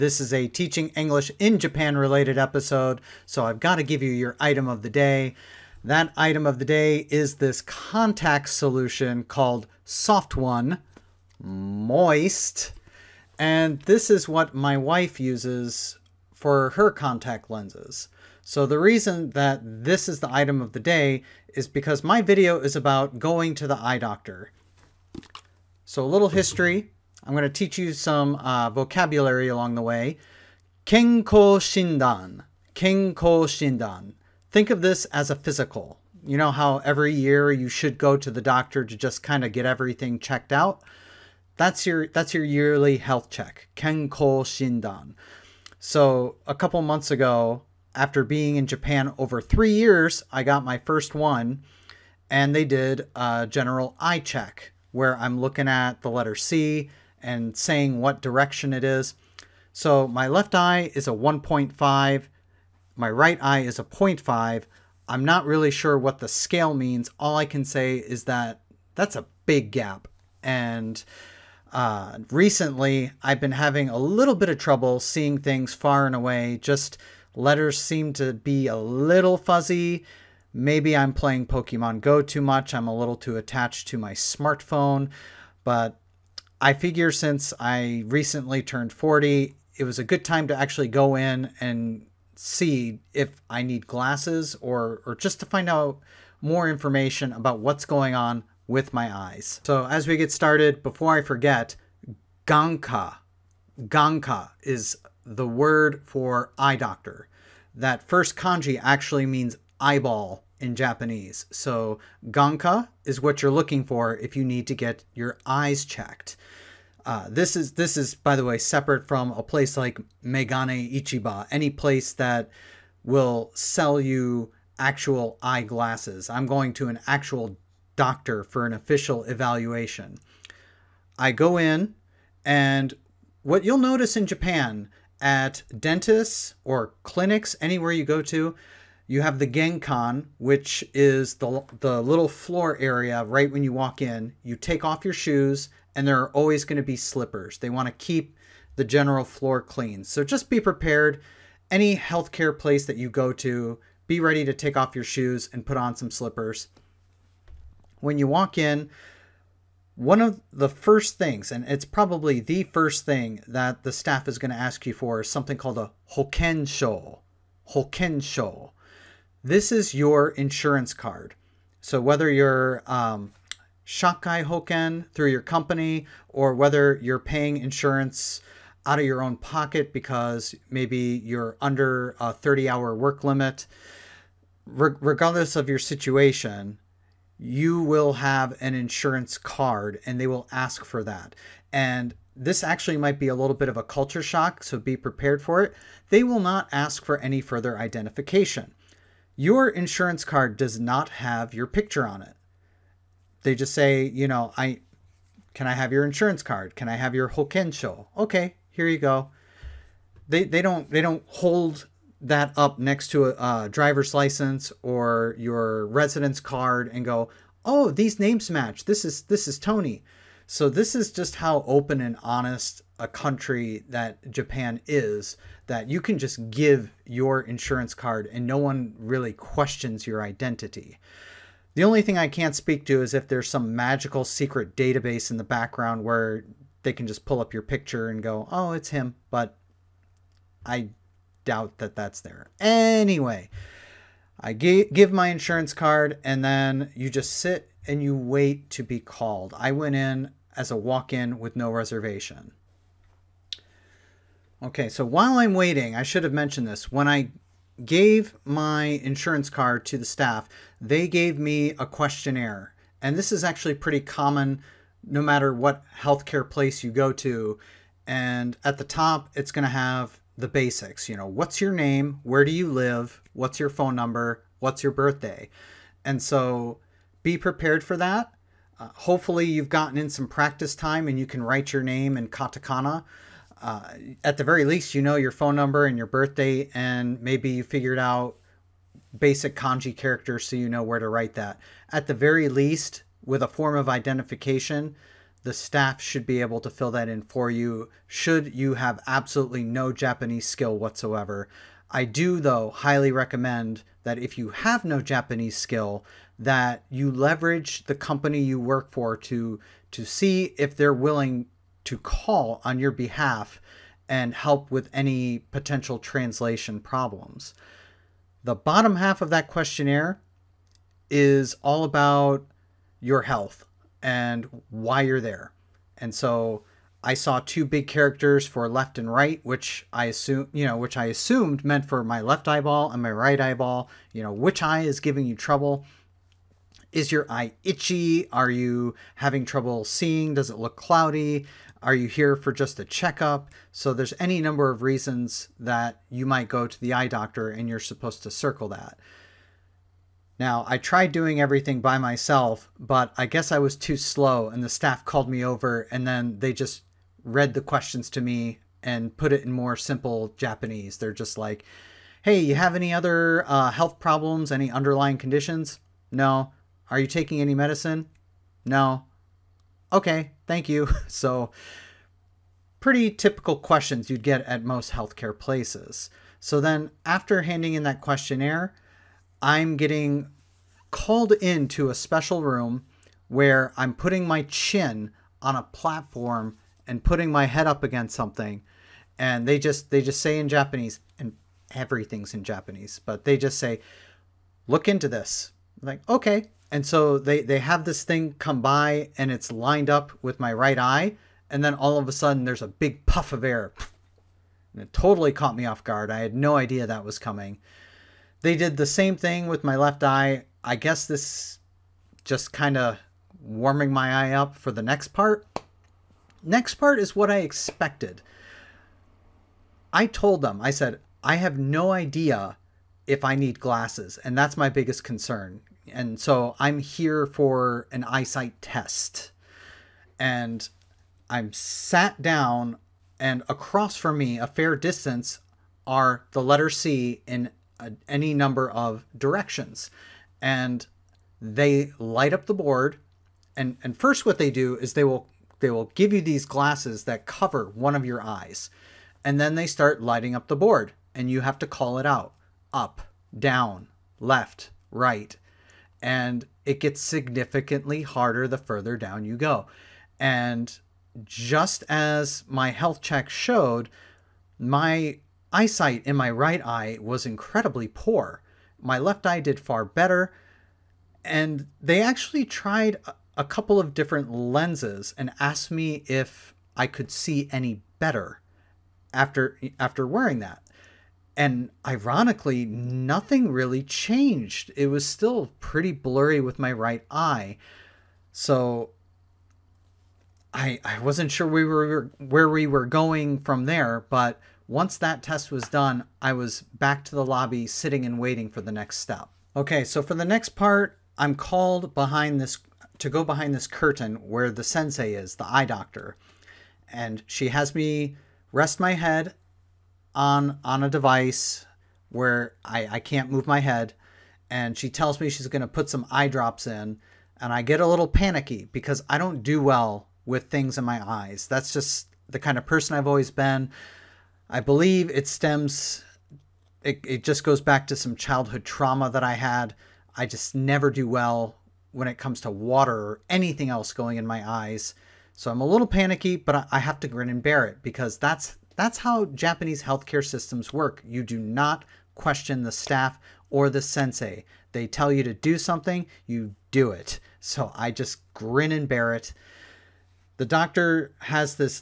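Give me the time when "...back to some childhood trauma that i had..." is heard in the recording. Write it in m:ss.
8:47.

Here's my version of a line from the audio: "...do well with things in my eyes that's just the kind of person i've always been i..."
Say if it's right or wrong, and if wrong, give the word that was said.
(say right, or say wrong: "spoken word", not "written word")
right.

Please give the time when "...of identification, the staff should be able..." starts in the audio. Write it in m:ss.
4:53.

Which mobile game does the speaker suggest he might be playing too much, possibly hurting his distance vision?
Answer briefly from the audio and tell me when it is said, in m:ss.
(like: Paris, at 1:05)
Pokemon Go, at 1:21.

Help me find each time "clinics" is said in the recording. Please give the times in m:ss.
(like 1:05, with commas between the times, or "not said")
2:17.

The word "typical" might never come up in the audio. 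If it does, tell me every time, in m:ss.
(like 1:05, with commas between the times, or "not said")
6:13.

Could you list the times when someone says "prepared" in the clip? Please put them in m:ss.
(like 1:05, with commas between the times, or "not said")
2:30, 3:14, 4:37.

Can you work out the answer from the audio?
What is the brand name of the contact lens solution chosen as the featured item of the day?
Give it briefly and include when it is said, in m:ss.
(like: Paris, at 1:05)
Soft One Moist, at 0:09.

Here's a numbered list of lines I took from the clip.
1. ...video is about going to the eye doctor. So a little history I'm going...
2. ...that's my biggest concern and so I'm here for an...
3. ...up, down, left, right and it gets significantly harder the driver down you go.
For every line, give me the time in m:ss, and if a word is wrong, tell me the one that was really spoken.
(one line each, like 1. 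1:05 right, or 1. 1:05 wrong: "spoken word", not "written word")
1. 0:22 right
2. 7:04 right
3. 7:32 wrong: "further", not "driver".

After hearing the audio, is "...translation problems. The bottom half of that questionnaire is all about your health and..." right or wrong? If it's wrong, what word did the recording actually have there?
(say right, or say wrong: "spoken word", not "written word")
right.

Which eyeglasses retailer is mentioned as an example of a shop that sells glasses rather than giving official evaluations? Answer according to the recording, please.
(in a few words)
Megane Ichiba.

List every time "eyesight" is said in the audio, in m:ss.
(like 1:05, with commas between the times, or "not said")
7:08, 7:45.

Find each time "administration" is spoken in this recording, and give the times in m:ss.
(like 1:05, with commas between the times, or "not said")
not said.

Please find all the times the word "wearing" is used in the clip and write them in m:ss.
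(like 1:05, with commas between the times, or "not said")
8:00.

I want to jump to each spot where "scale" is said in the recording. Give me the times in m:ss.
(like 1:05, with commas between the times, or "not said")
1:06.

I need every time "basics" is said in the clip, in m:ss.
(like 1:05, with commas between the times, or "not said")
4:30, 4:49.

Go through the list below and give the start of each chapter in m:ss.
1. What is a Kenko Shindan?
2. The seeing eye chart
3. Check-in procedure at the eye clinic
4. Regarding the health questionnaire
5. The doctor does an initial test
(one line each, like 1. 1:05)
1. 0:25
2. 6:16
3. 1:39
4. 4:12
5. 8:19.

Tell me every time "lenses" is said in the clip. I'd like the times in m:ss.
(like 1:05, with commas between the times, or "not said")
0:17, 7:54.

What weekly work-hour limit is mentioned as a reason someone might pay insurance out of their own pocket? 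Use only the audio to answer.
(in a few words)
30 hours.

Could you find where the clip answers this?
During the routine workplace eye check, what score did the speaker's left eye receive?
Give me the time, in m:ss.
1:01.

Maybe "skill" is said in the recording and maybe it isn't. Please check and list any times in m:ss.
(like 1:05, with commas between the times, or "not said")
5:00, 5:05.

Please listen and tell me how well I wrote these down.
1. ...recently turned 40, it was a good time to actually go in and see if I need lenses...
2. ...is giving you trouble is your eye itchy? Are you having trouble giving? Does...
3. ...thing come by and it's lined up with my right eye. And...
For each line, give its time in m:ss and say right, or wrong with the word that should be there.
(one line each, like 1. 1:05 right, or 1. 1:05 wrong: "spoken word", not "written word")
1. 1:28 wrong: "glasses", not "lenses"
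2. 5:34 wrong: "seeing", not "giving"
3. 6:38 right.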